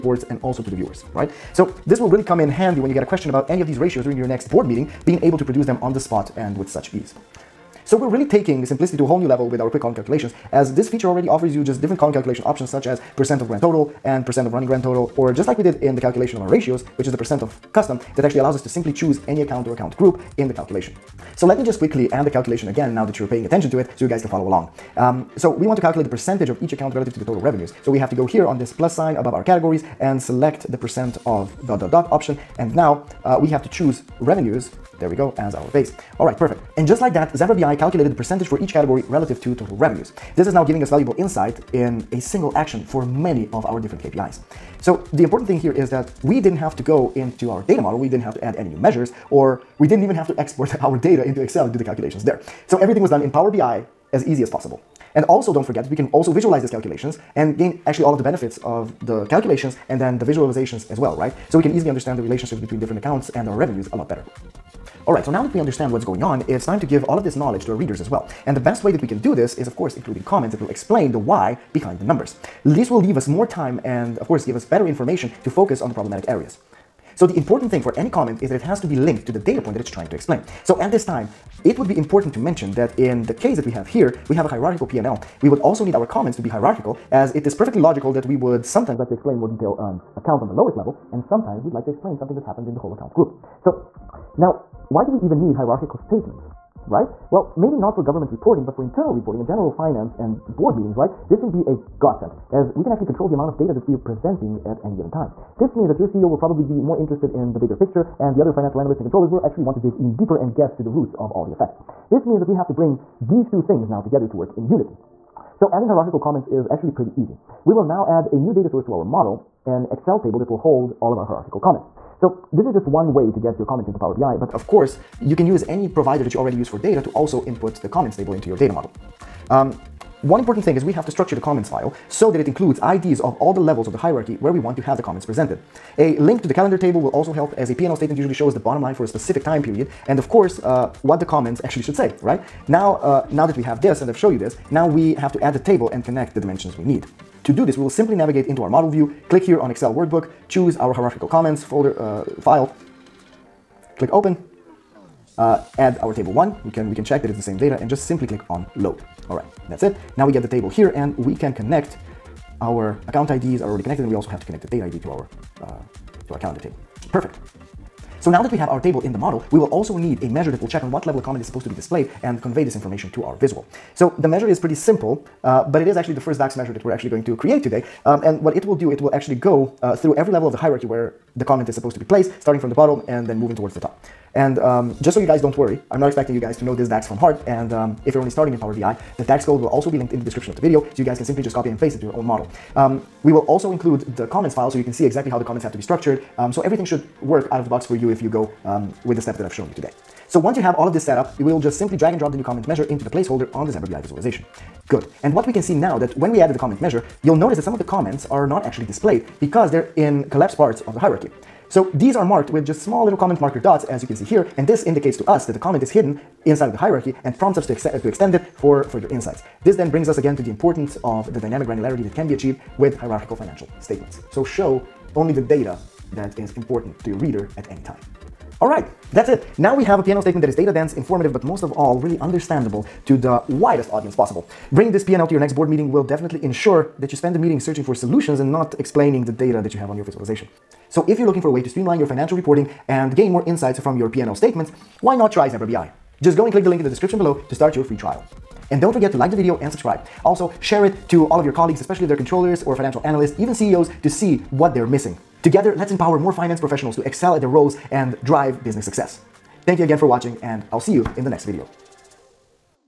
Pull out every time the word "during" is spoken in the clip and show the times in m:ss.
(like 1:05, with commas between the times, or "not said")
0:04.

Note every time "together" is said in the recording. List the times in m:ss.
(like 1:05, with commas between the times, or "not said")
1:53, 4:15.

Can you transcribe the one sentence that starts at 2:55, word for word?
Uh, but it is actually the first DAX measure that we're actually going to create today.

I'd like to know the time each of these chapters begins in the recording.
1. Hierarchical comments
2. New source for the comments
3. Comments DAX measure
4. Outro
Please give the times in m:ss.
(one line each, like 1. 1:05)
1. 1:03
2. 2:01
3. 2:48
4. 3:48.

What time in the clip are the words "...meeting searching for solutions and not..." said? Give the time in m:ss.
3:57.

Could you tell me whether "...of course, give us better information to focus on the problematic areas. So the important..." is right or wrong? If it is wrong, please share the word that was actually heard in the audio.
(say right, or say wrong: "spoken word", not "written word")
right.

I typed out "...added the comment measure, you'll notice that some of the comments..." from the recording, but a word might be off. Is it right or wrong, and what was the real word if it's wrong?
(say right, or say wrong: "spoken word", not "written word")
right.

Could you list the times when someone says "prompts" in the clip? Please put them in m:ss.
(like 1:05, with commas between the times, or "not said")
3:37.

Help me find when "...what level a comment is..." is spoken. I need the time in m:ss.
2:50.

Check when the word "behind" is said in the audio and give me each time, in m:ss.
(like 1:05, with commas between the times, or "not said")
1:11.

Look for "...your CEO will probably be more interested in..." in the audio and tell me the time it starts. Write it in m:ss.
1:45.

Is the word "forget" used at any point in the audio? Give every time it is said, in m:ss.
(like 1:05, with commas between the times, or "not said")
0:55, 4:08.